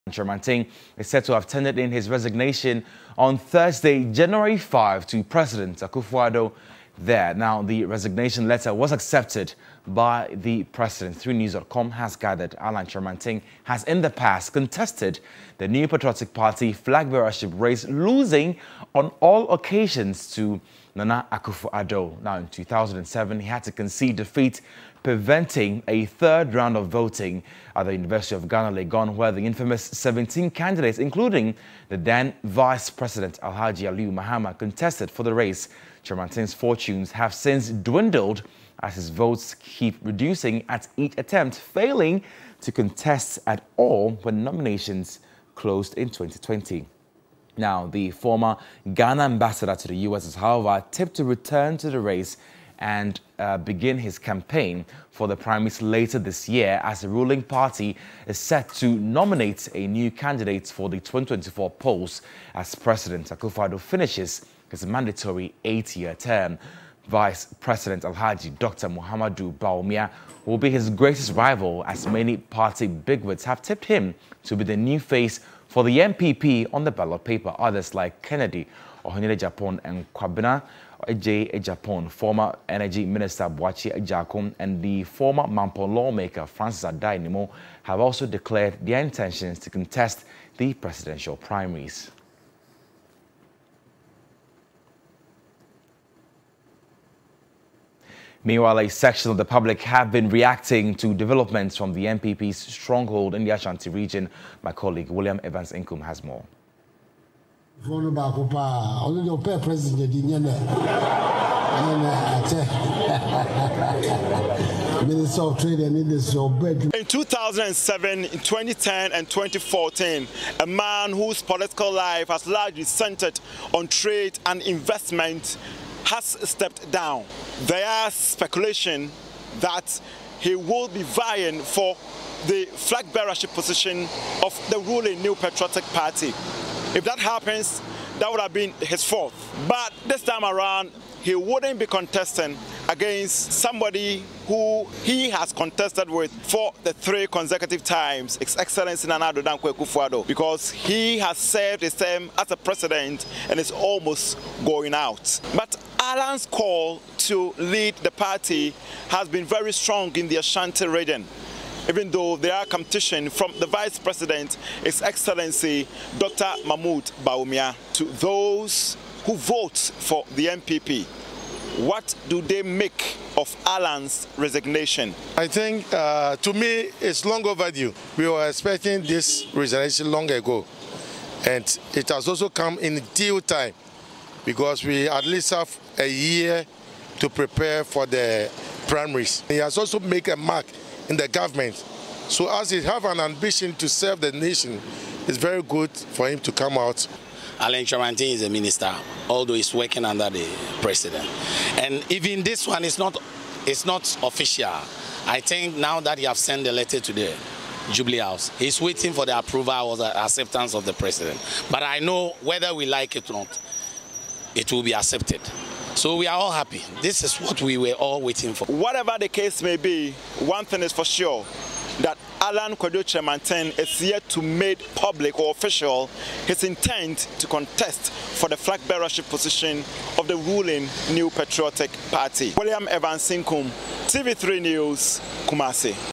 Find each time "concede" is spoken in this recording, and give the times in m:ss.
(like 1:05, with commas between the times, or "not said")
0:23.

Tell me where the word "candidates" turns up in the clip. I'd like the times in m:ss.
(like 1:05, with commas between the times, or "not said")
0:30, 1:00.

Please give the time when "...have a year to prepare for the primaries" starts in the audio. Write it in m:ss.
3:05.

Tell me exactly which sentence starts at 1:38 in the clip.
Meanwhile, a section of the public have been reacting to developments from the NPP's stronghold in the Ashanti region.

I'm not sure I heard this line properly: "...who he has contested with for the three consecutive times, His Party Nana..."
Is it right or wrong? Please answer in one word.
wrong.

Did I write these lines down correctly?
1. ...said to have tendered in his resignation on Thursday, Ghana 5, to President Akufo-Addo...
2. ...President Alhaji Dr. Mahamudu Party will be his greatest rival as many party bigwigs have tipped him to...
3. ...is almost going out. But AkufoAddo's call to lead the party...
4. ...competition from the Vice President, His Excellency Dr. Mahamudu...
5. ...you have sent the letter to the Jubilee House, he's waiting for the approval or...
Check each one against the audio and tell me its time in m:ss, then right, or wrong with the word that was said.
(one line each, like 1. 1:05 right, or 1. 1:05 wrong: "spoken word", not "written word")
1. 0:01 wrong: "January", not "Ghana"
2. 1:07 wrong: "Bawumia", not "Party"
3. 2:33 wrong: "Alan", not "AkufoAddo"
4. 2:42 right
5. 3:26 right.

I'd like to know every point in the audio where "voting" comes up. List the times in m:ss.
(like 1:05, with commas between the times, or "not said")
0:26.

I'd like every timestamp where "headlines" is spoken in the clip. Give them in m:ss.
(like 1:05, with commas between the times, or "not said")
not said.